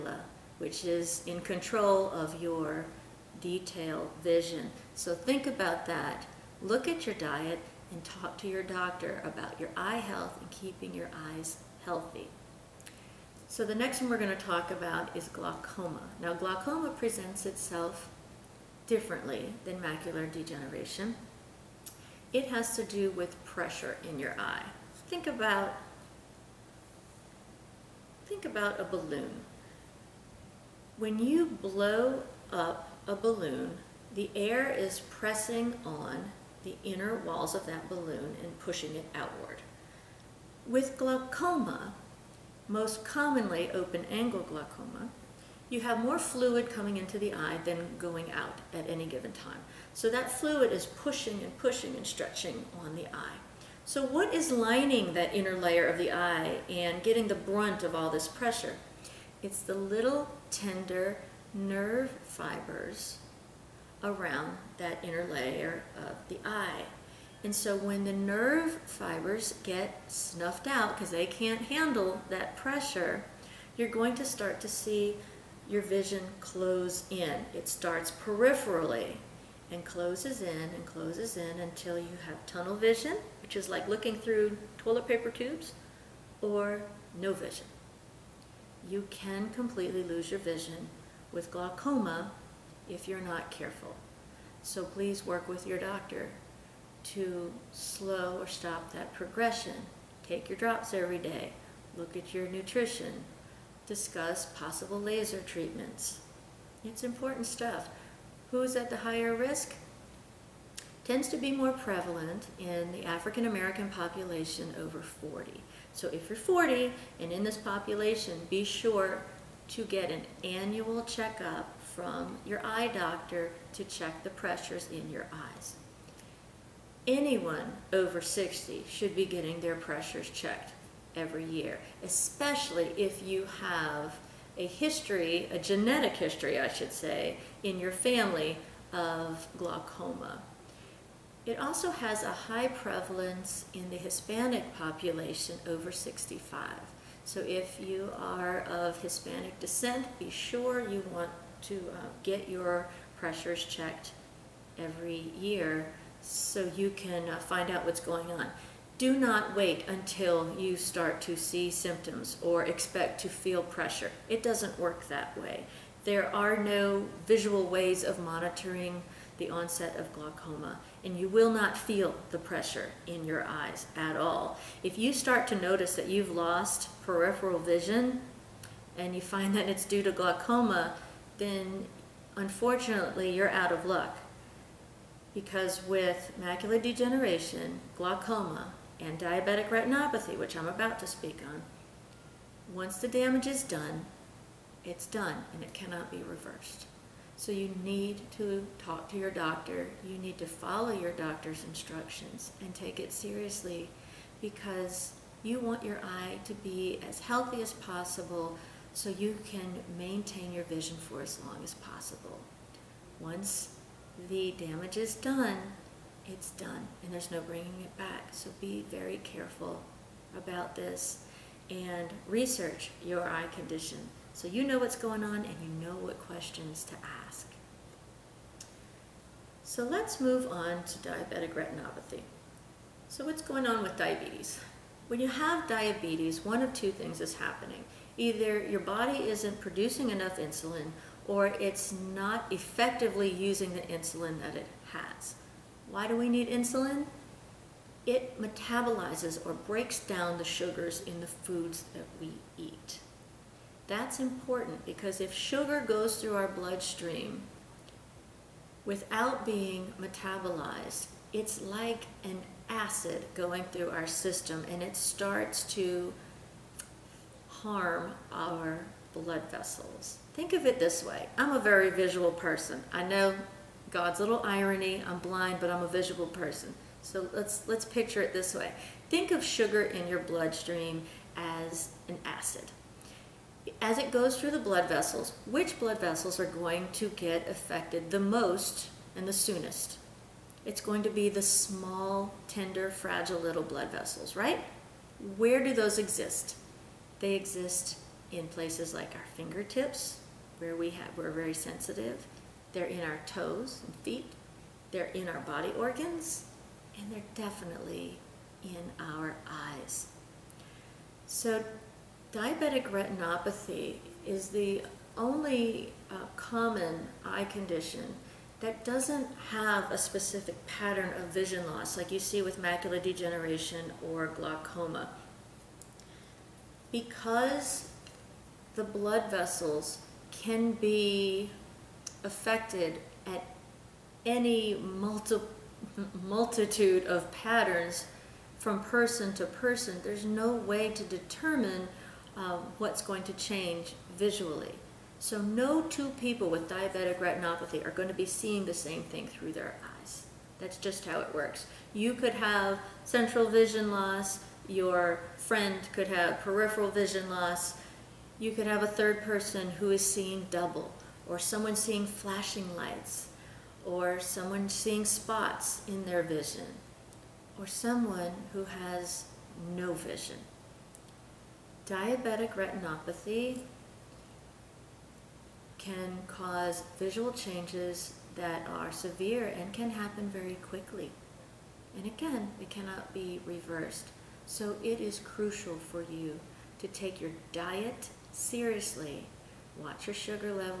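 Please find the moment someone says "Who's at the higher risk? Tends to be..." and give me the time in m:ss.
1:48.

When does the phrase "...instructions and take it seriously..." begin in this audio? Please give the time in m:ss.
3:21.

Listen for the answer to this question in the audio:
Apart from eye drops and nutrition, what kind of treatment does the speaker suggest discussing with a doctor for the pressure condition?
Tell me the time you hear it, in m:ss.
1:44.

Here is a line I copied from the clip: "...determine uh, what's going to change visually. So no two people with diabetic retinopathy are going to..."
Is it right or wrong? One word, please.
right.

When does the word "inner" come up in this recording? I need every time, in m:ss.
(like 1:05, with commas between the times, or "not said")
0:36, 0:55, 1:05.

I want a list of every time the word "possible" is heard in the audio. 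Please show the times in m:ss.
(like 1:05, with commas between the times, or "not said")
1:44, 3:27, 3:31.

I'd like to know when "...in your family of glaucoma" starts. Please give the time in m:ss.
2:17.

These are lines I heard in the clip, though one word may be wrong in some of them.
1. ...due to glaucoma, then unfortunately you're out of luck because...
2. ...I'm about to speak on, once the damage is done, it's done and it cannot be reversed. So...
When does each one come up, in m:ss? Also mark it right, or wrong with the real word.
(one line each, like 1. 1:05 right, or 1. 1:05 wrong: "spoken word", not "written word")
1. 2:59 right
2. 3:10 right.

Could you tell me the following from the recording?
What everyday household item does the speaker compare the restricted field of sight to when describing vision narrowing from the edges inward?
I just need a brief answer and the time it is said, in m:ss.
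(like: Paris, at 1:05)
toilet paper tubes, at 1:24.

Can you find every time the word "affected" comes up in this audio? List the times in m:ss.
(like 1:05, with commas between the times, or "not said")
4:47, 5:32.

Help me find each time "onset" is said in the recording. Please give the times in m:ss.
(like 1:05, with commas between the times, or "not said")
2:49.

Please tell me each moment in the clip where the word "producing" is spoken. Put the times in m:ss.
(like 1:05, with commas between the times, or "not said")
3:59.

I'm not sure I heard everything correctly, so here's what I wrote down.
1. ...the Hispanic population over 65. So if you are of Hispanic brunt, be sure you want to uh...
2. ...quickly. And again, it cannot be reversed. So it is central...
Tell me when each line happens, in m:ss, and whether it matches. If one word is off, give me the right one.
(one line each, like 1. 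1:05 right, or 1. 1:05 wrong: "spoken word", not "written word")
1. 2:23 wrong: "descent", not "brunt"
2. 6:20 wrong: "crucial", not "central".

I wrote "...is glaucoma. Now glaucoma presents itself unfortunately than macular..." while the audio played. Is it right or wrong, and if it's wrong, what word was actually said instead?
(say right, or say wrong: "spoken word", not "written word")
wrong: "differently", not "unfortunately".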